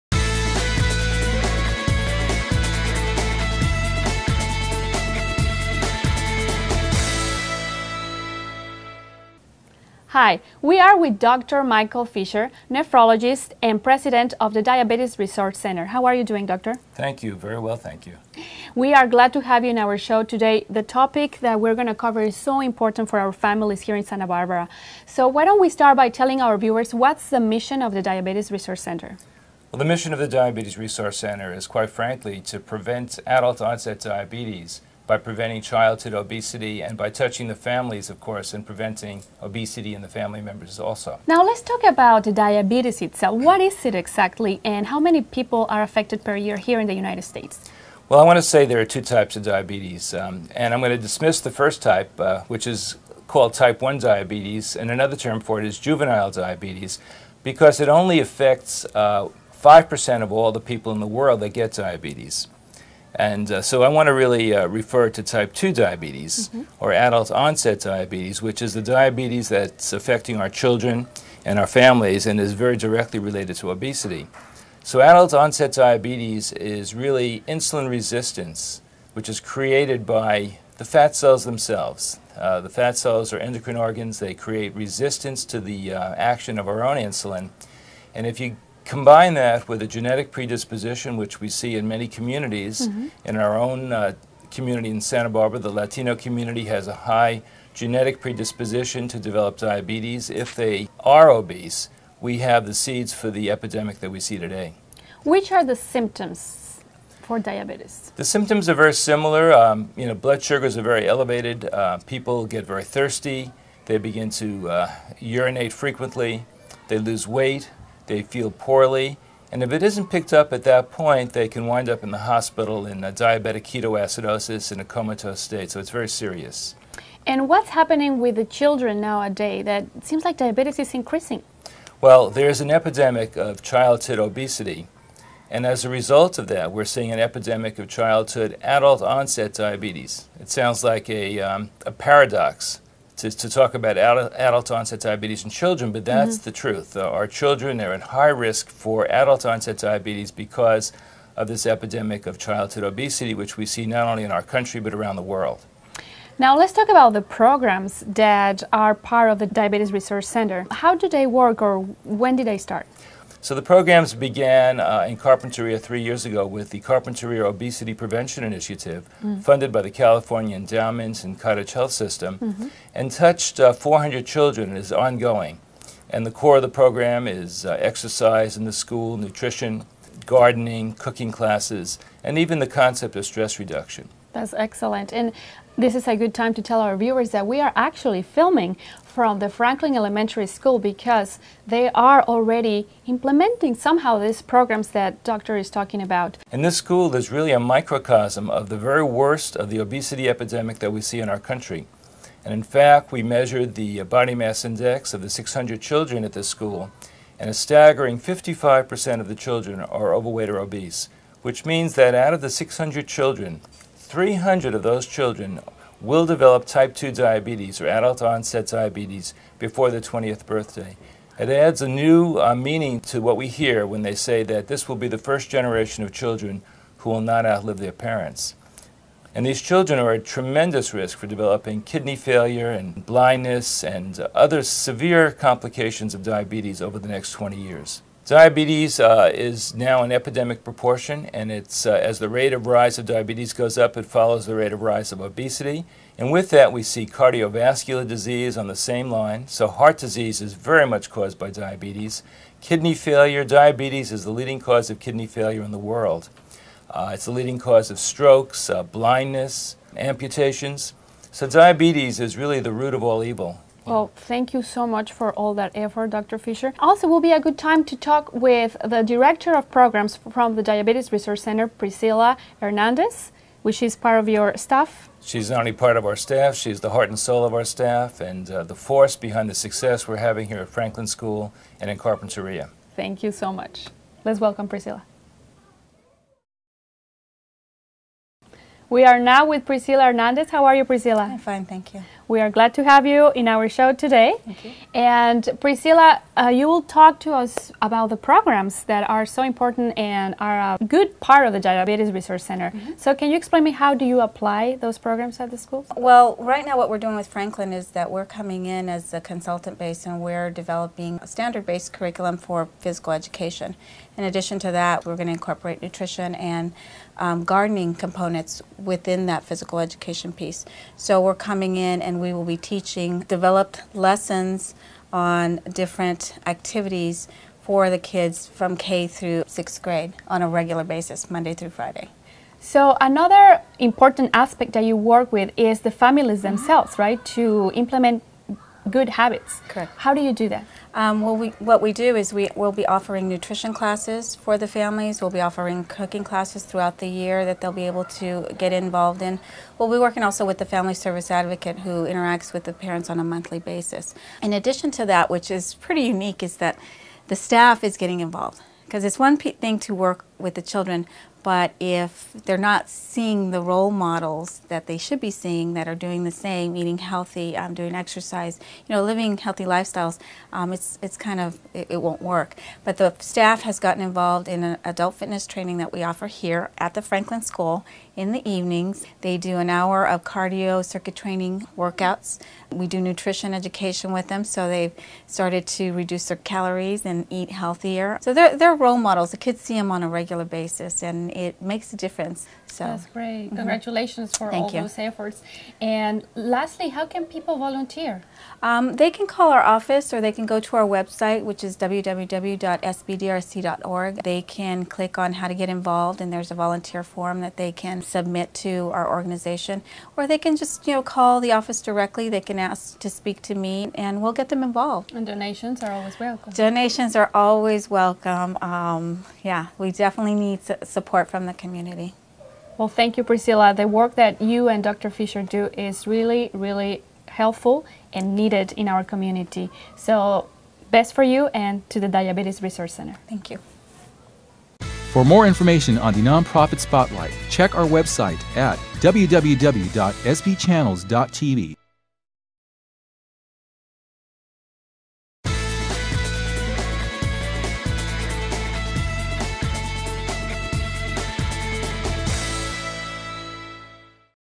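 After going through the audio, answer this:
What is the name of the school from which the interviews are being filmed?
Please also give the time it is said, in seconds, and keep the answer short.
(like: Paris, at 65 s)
Franklin Elementary School, at 189 s.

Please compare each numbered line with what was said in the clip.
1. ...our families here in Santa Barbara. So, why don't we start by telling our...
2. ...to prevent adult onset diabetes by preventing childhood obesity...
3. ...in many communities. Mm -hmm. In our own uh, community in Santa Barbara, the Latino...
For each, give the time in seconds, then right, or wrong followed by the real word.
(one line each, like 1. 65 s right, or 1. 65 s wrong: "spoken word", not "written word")
1. 23 s right
2. 32 s right
3. 91 s right.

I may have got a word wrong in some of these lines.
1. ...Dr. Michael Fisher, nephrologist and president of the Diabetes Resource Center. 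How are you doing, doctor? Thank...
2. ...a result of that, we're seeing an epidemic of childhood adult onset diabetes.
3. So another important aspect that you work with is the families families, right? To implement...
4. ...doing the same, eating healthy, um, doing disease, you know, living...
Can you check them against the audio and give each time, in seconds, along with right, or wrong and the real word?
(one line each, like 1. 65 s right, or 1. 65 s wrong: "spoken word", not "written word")
1. 11 s right
2. 135 s right
3. 332 s wrong: "themselves", not "families"
4. 365 s wrong: "exercise", not "disease".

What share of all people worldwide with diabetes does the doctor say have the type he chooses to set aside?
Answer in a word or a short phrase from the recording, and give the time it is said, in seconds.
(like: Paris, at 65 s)
5%, at 58 s.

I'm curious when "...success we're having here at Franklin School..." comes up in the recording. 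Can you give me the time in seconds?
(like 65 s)
279 s.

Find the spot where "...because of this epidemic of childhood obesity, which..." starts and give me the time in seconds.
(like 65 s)
150 s.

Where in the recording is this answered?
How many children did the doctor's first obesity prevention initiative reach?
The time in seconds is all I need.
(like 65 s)
173 s.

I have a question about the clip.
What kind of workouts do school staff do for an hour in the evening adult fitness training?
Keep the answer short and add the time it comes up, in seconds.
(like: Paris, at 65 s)
cardio circuit training, at 380 s.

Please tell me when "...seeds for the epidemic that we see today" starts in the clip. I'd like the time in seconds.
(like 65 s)
102 s.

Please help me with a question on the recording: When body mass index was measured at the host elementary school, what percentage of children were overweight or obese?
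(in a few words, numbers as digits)
55%.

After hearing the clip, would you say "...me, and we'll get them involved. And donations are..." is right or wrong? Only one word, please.
right.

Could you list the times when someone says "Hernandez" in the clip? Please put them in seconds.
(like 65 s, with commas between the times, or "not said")
272 s, 290 s.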